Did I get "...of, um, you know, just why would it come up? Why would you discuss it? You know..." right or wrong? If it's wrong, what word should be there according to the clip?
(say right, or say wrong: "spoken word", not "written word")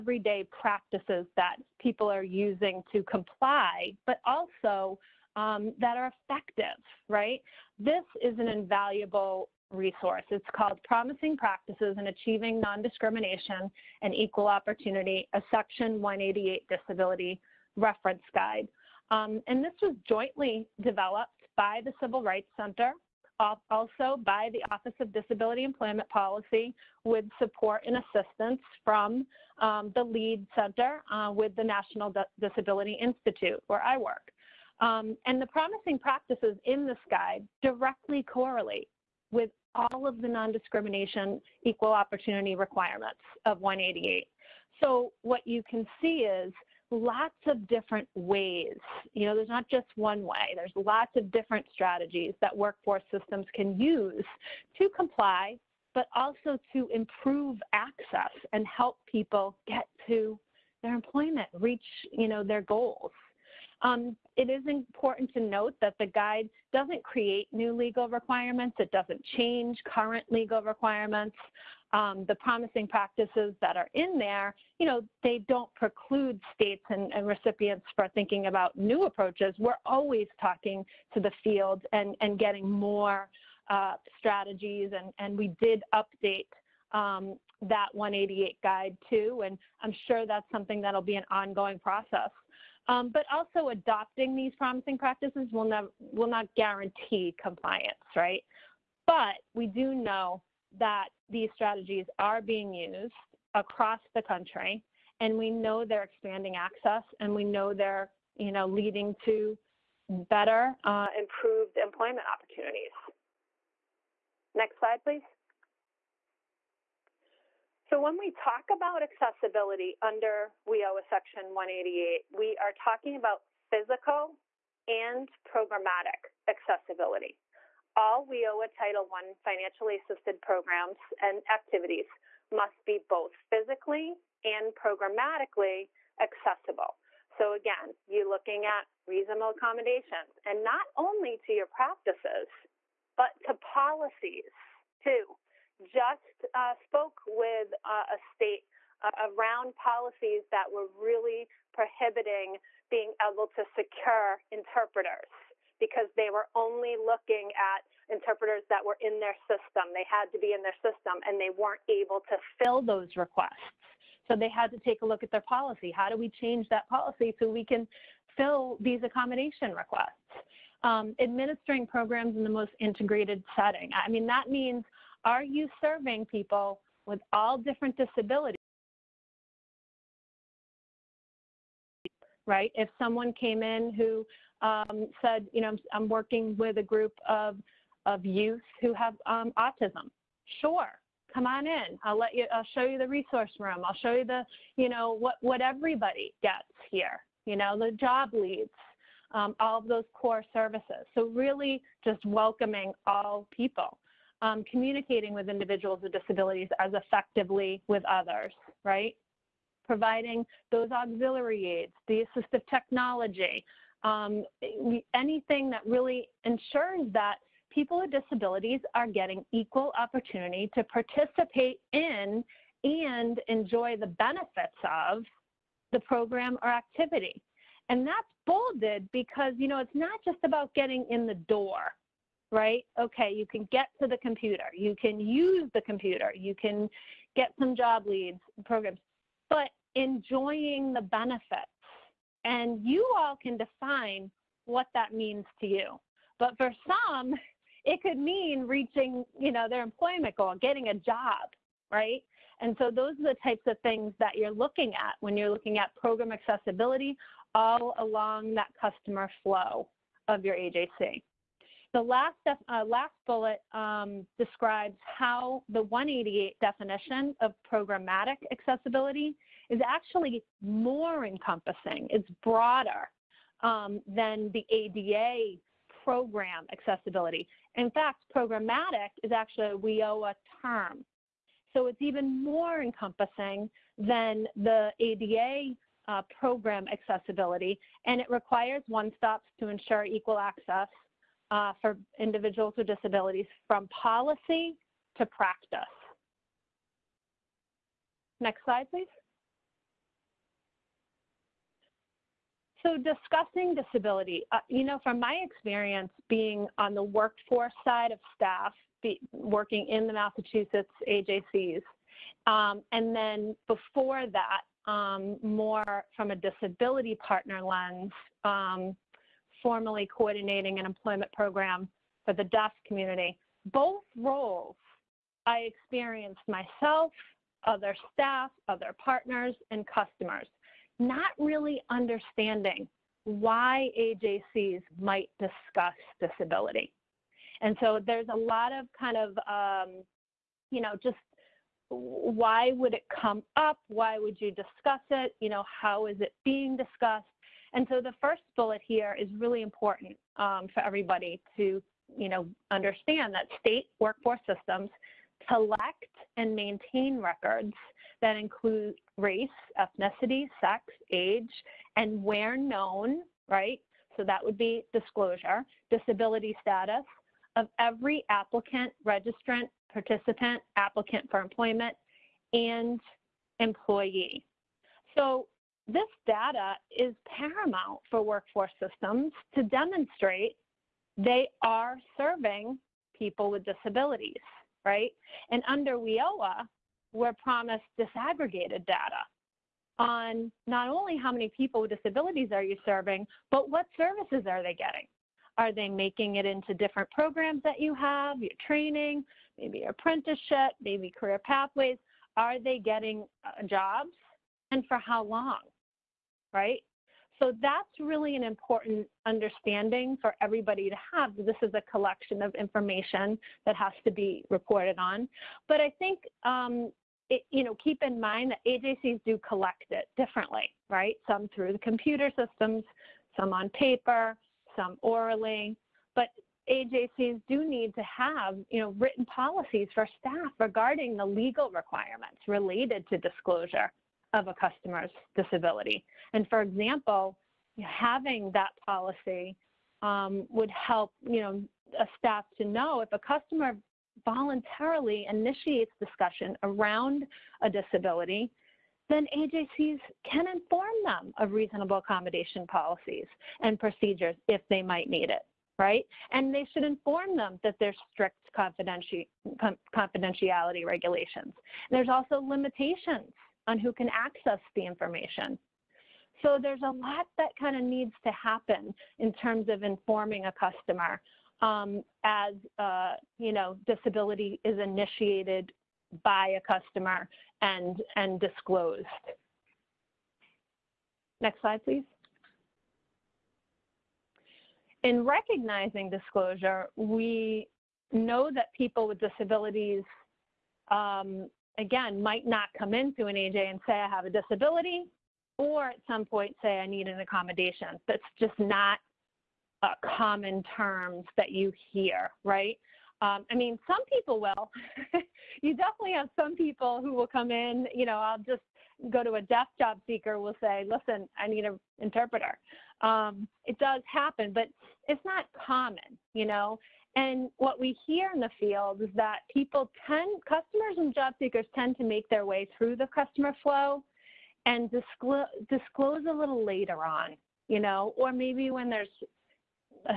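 right.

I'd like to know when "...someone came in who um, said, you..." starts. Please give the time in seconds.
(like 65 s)
182 s.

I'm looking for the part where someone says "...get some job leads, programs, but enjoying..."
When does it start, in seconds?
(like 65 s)
237 s.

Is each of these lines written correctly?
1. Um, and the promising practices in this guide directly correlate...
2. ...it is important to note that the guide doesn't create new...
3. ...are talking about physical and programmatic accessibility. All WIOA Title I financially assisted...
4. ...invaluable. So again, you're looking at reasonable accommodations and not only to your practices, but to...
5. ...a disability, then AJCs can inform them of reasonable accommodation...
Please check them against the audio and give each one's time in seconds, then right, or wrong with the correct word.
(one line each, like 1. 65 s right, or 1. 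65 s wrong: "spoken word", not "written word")
1. 34 s right
2. 64 s right
3. 122 s right
4. 136 s wrong: "accessible", not "invaluable"
5. 447 s right.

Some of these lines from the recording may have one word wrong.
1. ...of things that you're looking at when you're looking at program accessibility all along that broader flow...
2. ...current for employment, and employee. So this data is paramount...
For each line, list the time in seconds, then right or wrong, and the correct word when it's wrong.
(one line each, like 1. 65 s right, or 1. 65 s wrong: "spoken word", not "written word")
1. 253 s wrong: "customer", not "broader"
2. 370 s wrong: "applicant", not "current".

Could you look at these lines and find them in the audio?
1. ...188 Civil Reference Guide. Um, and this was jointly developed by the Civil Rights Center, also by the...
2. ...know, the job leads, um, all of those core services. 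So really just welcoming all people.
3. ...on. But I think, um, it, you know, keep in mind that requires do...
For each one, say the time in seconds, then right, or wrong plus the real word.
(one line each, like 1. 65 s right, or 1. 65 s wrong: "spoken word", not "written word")
1. 16 s wrong: "Disability", not "Civil"
2. 197 s right
3. 414 s wrong: "agencies", not "requires".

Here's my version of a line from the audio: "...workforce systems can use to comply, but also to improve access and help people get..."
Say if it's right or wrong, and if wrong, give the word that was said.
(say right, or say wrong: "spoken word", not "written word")
right.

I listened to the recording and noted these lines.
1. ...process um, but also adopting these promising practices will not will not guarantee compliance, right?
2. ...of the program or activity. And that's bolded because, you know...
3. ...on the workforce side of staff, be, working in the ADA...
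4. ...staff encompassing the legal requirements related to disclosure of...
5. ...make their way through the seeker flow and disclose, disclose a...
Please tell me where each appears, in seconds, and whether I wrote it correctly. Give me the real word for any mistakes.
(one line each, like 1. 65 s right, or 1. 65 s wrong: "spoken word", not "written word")
1. 91 s right
2. 224 s right
3. 306 s wrong: "Massachusetts", not "ADA"
4. 430 s wrong: "regarding", not "encompassing"
5. 522 s wrong: "customer", not "seeker".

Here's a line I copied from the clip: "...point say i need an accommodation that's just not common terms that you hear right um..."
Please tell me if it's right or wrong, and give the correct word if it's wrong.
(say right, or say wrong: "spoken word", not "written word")
right.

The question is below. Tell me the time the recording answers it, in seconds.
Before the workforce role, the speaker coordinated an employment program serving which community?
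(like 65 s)
322 s.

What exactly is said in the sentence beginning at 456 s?
And they should inform them that there's strict confidentiality regulations.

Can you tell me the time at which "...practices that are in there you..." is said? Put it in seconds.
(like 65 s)
72 s.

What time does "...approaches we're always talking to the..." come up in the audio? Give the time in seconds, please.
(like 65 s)
79 s.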